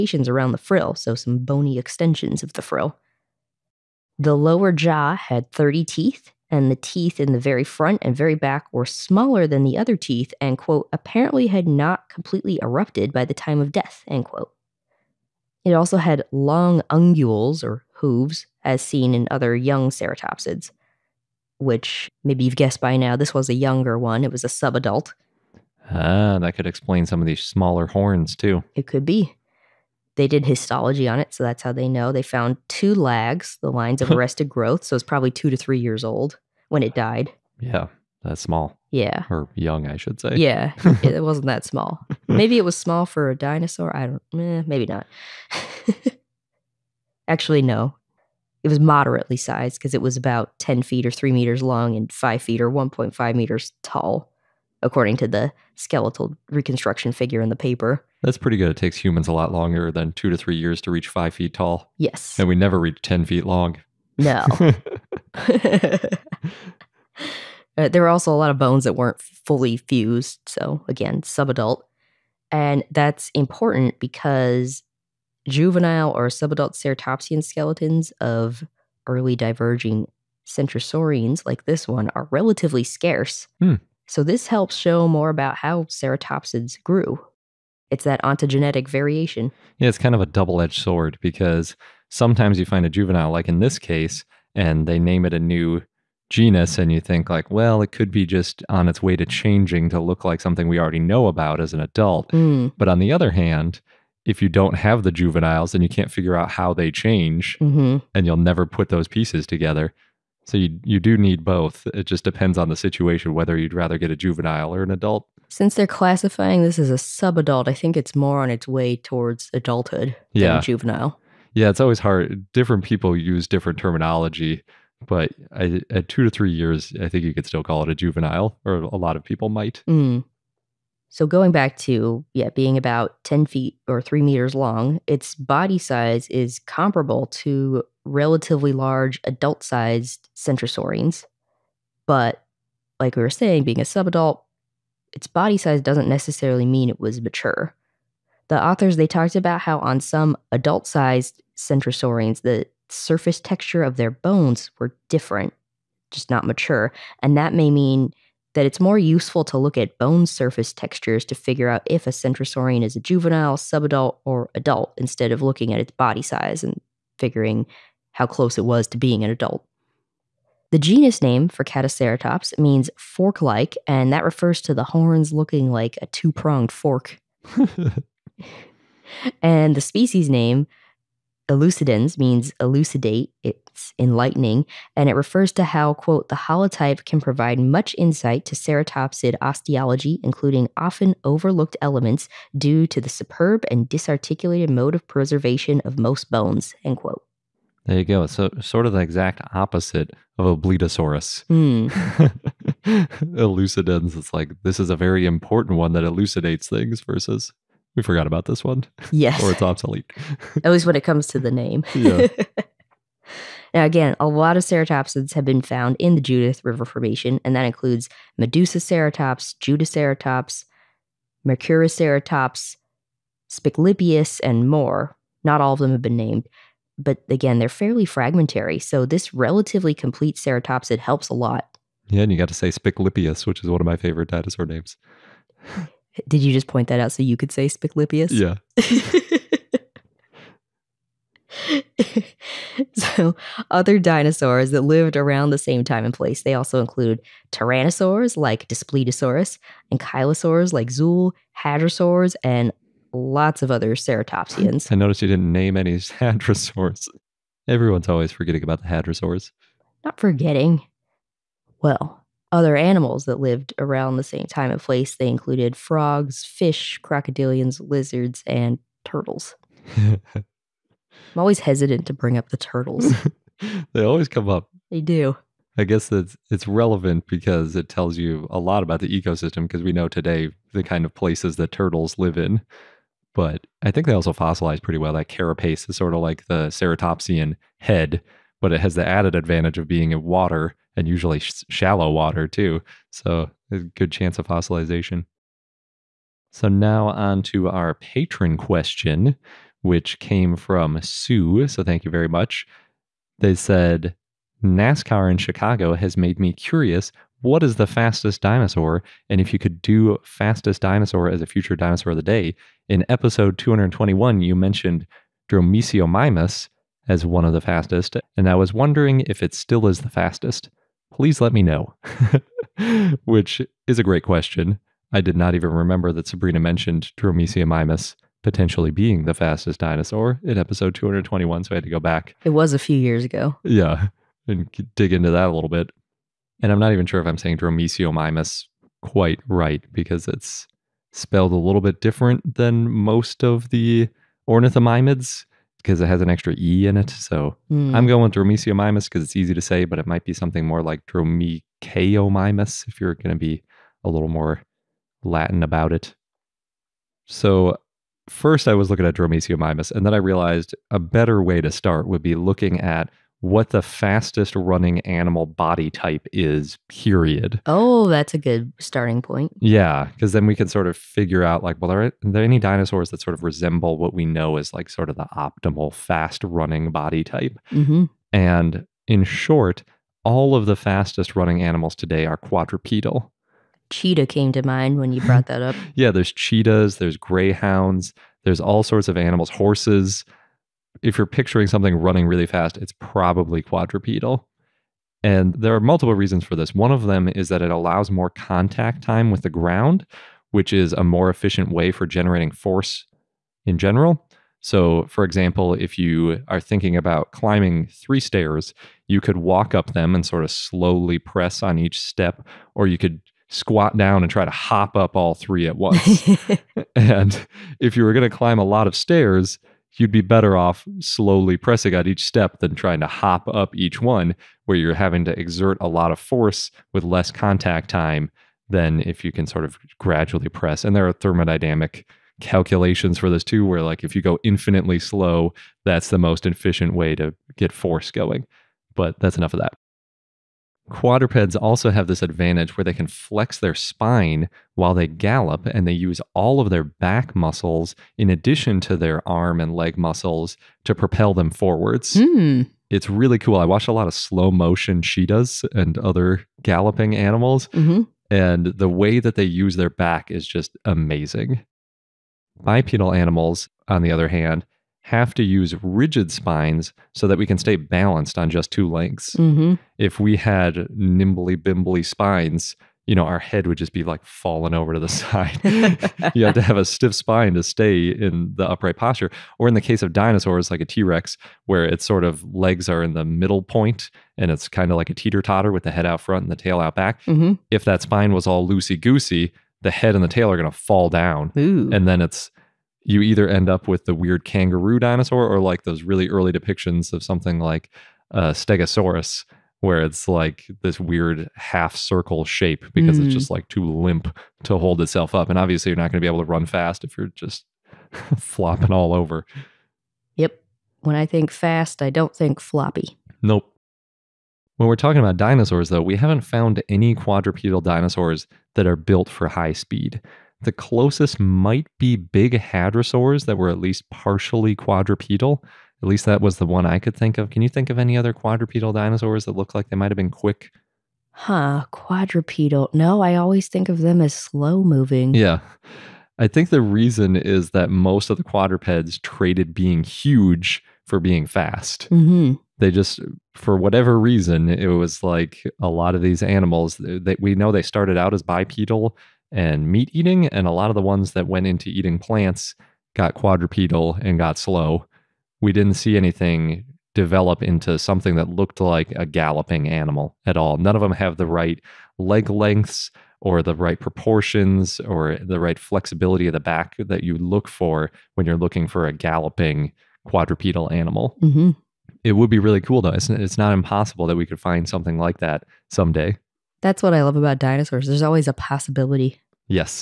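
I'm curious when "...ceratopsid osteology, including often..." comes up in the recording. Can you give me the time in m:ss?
3:08.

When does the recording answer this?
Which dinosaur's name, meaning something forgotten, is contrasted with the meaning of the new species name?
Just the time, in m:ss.
3:20.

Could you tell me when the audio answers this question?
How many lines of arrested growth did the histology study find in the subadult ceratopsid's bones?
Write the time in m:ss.
0:32.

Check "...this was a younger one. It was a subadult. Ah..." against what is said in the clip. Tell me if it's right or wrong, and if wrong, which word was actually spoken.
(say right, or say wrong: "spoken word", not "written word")
right.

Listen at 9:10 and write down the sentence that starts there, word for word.
And a lot of the ones that went into eating plants got quadrupedal and got slow.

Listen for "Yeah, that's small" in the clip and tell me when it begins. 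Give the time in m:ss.
0:37.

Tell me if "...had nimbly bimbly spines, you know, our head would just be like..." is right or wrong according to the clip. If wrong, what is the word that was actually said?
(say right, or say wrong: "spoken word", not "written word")
right.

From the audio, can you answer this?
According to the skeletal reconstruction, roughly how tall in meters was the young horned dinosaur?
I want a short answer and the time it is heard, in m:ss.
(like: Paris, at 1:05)
1.5 meters, at 0:52.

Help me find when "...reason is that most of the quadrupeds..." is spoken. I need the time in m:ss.
8:56.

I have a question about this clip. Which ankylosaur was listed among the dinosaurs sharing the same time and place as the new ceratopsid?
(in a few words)
Zuul.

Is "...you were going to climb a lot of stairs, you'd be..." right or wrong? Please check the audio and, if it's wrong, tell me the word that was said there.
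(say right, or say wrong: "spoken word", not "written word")
right.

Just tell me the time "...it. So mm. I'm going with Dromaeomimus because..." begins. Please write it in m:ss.
5:46.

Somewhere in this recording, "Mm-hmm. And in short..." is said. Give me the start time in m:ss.
6:17.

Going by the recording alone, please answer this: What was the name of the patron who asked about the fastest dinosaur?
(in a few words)
Sue.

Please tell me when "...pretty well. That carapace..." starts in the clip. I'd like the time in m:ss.
4:44.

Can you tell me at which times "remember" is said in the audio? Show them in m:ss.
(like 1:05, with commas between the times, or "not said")
5:25.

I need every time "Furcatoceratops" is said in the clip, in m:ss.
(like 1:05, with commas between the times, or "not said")
2:51.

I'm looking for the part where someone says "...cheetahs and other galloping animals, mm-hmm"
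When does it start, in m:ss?
7:35.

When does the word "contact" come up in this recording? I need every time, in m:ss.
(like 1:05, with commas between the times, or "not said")
6:38, 7:07.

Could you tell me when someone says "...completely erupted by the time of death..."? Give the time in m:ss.
0:12.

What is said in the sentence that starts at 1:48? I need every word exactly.
and you'll never put those pieces together.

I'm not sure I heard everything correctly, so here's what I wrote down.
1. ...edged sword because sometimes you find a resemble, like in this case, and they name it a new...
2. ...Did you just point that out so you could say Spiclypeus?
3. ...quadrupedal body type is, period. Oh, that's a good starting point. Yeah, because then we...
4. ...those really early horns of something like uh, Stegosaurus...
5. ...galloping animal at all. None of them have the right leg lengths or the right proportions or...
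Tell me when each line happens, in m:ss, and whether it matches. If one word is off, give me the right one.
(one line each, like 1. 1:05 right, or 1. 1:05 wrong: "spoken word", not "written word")
1. 1:30 wrong: "juvenile", not "resemble"
2. 3:56 right
3. 6:05 wrong: "animal", not "quadrupedal"
4. 8:15 wrong: "depictions", not "horns"
5. 9:19 right.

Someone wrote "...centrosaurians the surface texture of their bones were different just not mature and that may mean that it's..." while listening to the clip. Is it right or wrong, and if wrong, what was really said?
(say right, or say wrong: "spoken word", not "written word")
right.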